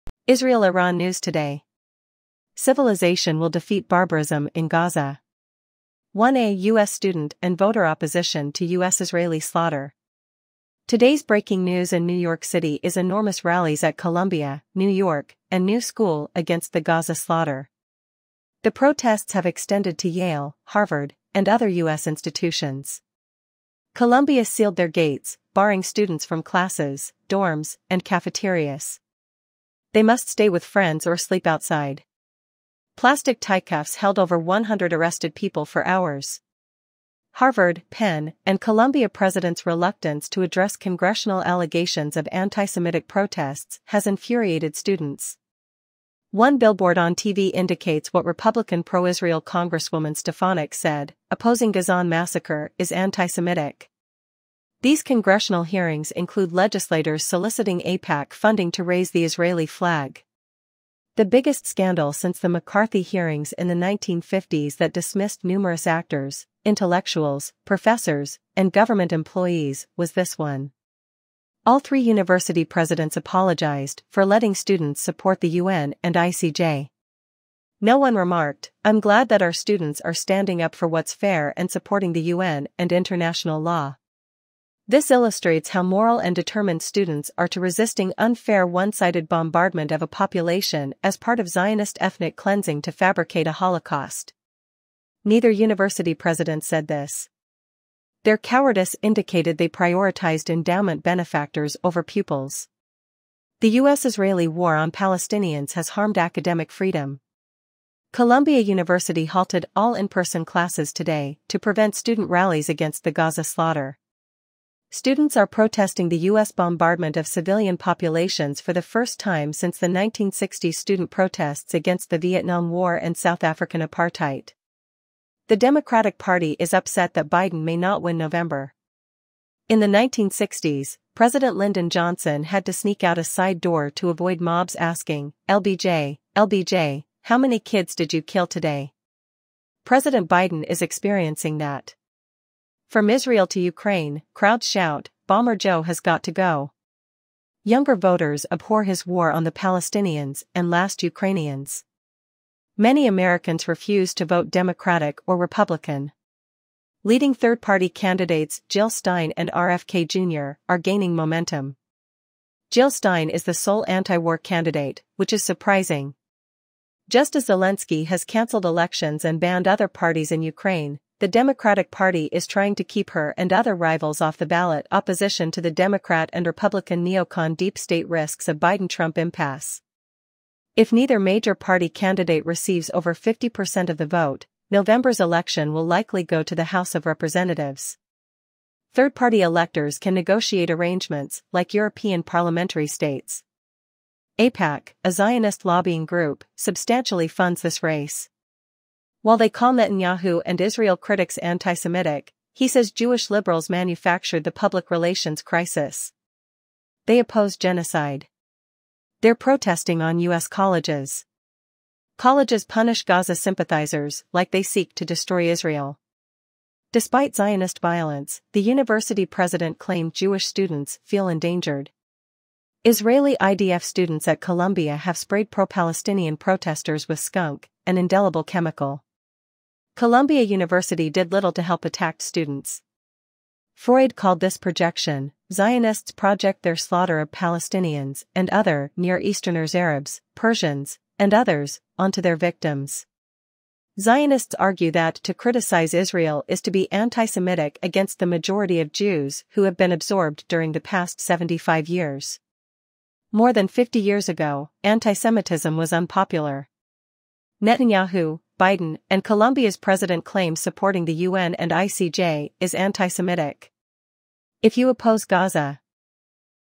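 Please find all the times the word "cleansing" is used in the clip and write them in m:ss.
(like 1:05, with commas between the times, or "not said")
1:32.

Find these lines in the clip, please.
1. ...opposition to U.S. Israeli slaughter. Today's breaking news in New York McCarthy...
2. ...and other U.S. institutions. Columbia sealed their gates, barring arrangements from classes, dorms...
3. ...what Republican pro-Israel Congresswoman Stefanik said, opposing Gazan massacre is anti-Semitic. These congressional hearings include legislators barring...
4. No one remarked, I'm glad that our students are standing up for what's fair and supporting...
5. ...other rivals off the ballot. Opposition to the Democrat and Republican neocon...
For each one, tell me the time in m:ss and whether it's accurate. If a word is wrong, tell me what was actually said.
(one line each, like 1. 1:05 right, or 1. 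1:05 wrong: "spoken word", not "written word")
1. 0:07 wrong: "City", not "McCarthy"
2. 0:21 wrong: "students", not "arrangements"
3. 0:48 wrong: "soliciting", not "barring"
4. 1:17 right
5. 2:53 right.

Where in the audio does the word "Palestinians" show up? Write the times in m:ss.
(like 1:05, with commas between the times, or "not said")
1:44, 2:29, 3:45, 3:57.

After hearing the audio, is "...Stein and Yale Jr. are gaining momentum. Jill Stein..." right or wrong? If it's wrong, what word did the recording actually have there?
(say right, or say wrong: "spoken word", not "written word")
wrong: "RFK", not "Yale".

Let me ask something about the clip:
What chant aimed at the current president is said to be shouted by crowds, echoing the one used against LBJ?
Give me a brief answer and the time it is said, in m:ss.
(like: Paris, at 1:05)
Bomber Joe has got to go, at 2:25.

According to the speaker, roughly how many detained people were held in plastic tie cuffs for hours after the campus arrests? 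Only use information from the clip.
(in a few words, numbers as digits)
over 100.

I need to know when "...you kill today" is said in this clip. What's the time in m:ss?
2:18.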